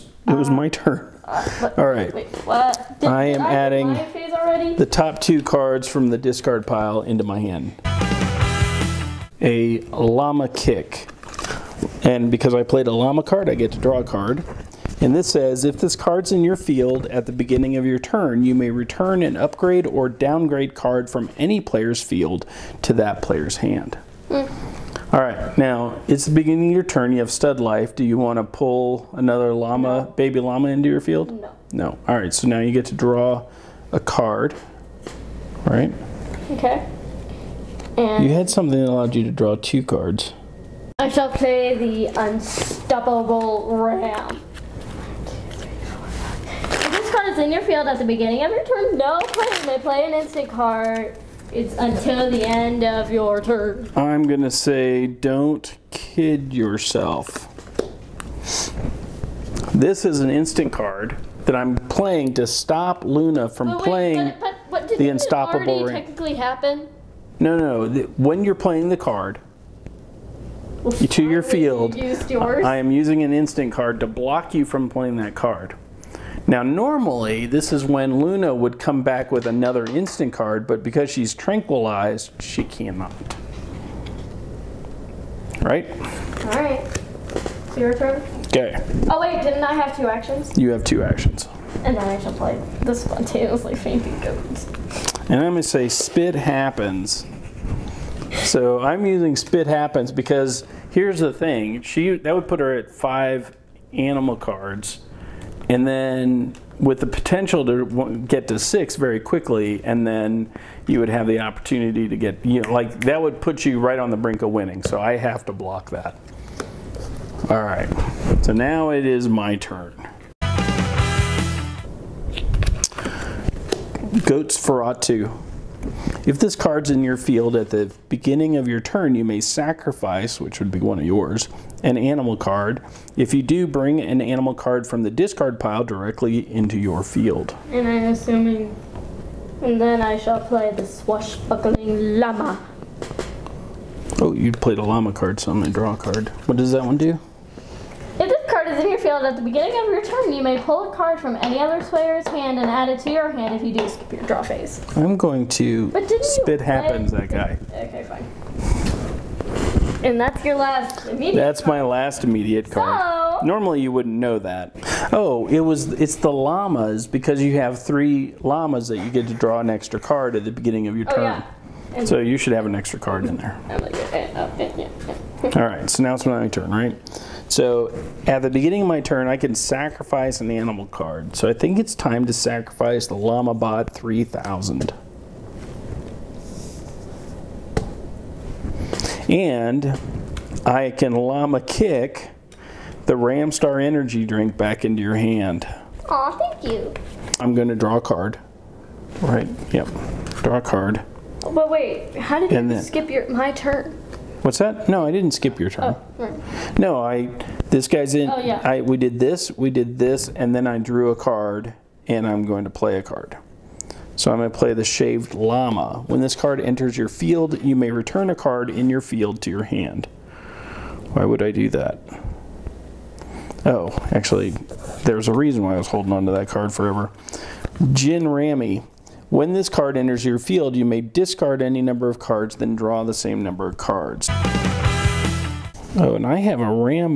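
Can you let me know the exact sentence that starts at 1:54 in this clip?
So I have to block that.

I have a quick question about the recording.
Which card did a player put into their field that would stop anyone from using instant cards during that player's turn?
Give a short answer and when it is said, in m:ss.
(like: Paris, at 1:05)
The Unstoppable Ram, at 0:41.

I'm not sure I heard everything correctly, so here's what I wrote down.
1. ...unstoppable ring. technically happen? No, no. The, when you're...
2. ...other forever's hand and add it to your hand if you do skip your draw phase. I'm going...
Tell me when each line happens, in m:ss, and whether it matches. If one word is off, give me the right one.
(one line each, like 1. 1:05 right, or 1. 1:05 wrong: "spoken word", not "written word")
1. 1:05 right
2. 2:31 wrong: "player", not "forever".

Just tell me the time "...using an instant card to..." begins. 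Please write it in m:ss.
1:12.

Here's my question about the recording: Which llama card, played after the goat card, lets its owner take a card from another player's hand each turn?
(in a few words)
Swashbuckling Llama.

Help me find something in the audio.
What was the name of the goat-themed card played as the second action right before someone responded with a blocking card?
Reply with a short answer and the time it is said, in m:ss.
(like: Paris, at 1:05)
Spontaneously Fainting Goats, at 1:32.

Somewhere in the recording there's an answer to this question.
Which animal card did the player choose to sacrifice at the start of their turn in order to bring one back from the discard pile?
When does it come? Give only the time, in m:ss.
3:03.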